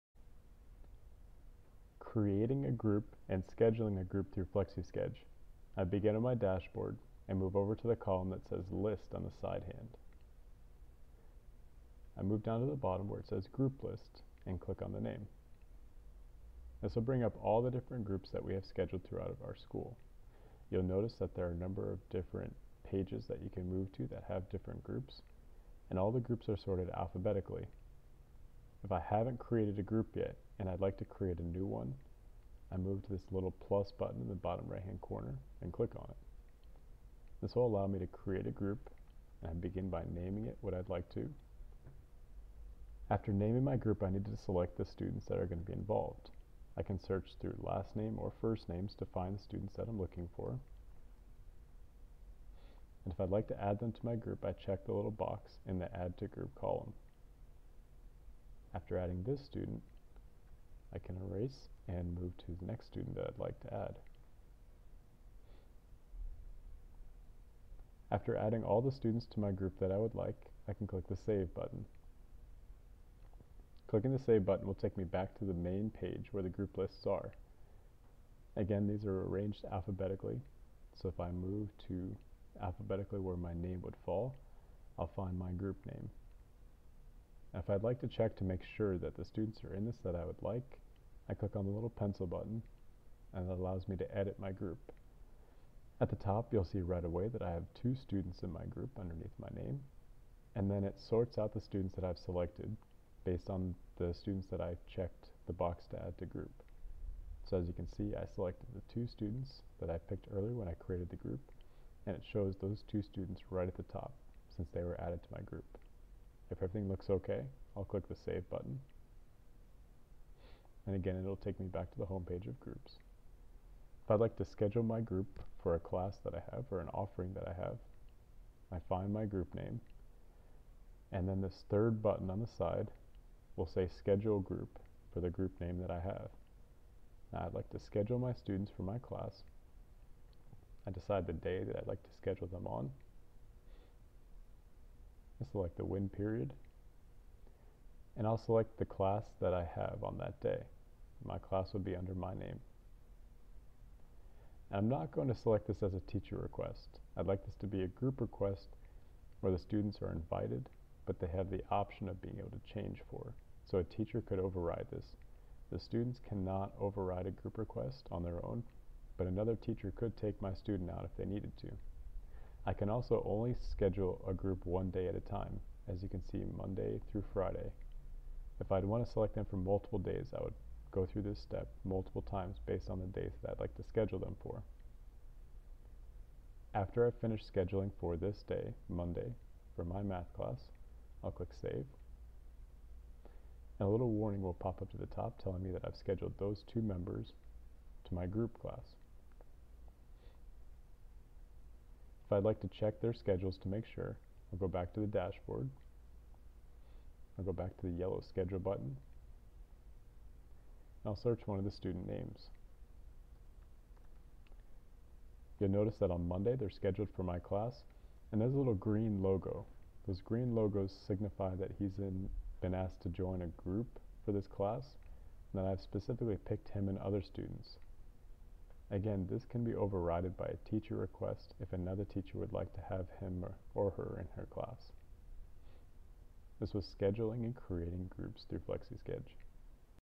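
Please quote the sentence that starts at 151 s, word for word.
My class would be under my name.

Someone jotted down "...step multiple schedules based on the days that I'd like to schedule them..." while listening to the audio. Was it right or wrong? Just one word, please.
wrong.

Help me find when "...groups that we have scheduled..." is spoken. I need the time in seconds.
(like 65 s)
18 s.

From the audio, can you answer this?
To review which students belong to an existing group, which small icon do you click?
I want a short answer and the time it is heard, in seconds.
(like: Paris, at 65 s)
pencil button, at 91 s.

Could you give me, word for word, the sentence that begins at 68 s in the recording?
After adding all the students to my group that I would like, I can click the Save button.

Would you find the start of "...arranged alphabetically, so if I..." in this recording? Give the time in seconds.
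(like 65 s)
79 s.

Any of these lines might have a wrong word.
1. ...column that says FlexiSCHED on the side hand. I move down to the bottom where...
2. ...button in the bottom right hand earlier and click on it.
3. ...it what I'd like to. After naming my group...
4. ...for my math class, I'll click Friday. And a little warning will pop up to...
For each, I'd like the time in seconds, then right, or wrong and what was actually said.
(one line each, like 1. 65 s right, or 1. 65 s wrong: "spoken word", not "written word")
1. 7 s wrong: "List", not "FlexiSCHED"
2. 33 s wrong: "corner", not "earlier"
3. 40 s right
4. 189 s wrong: "Save", not "Friday".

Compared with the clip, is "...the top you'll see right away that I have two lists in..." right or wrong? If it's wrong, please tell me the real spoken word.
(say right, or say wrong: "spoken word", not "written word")
wrong: "students", not "lists".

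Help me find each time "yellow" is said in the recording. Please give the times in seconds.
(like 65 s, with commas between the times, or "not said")
207 s.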